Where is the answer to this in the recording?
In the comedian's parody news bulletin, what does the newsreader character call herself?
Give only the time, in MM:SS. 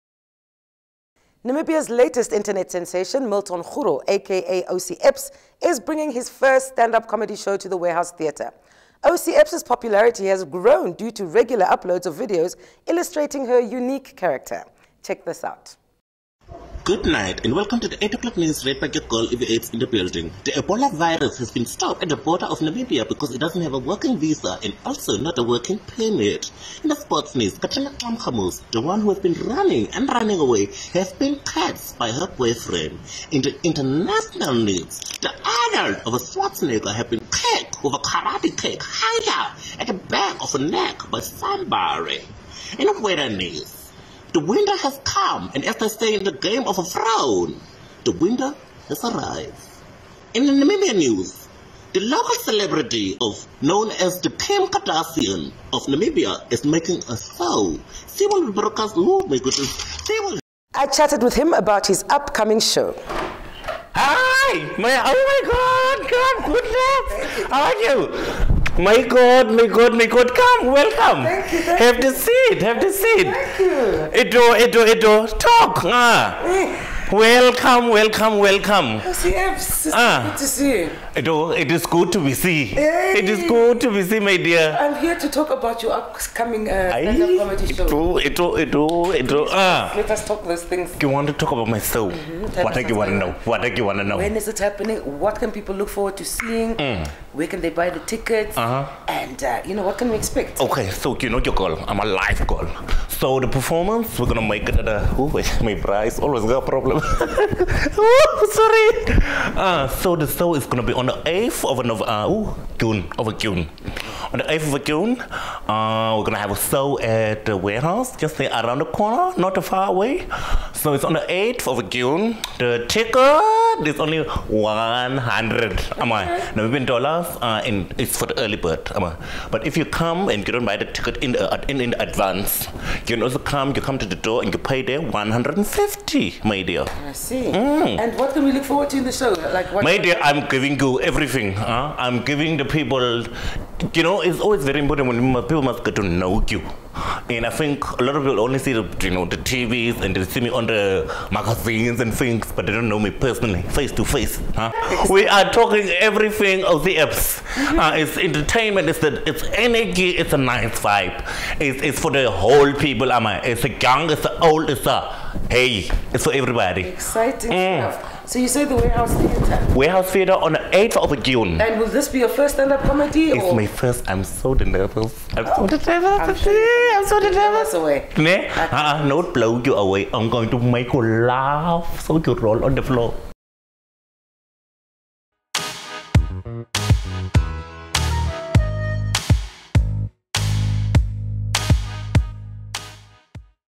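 00:19.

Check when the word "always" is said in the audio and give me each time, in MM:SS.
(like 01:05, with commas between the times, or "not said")
01:46, 02:24.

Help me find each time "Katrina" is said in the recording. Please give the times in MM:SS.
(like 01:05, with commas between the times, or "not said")
00:27.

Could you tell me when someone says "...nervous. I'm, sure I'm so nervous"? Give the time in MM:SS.
02:55.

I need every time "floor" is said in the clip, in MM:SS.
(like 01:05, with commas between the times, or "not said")
03:02.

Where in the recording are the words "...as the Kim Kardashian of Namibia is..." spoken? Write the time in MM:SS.
00:53.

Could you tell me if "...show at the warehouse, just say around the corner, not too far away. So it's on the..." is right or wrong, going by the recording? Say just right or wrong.
right.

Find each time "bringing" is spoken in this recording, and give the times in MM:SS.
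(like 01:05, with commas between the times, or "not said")
00:05.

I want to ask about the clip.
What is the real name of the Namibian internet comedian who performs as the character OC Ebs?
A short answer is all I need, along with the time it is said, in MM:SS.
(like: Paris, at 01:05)
Milton Xuro, at 00:03.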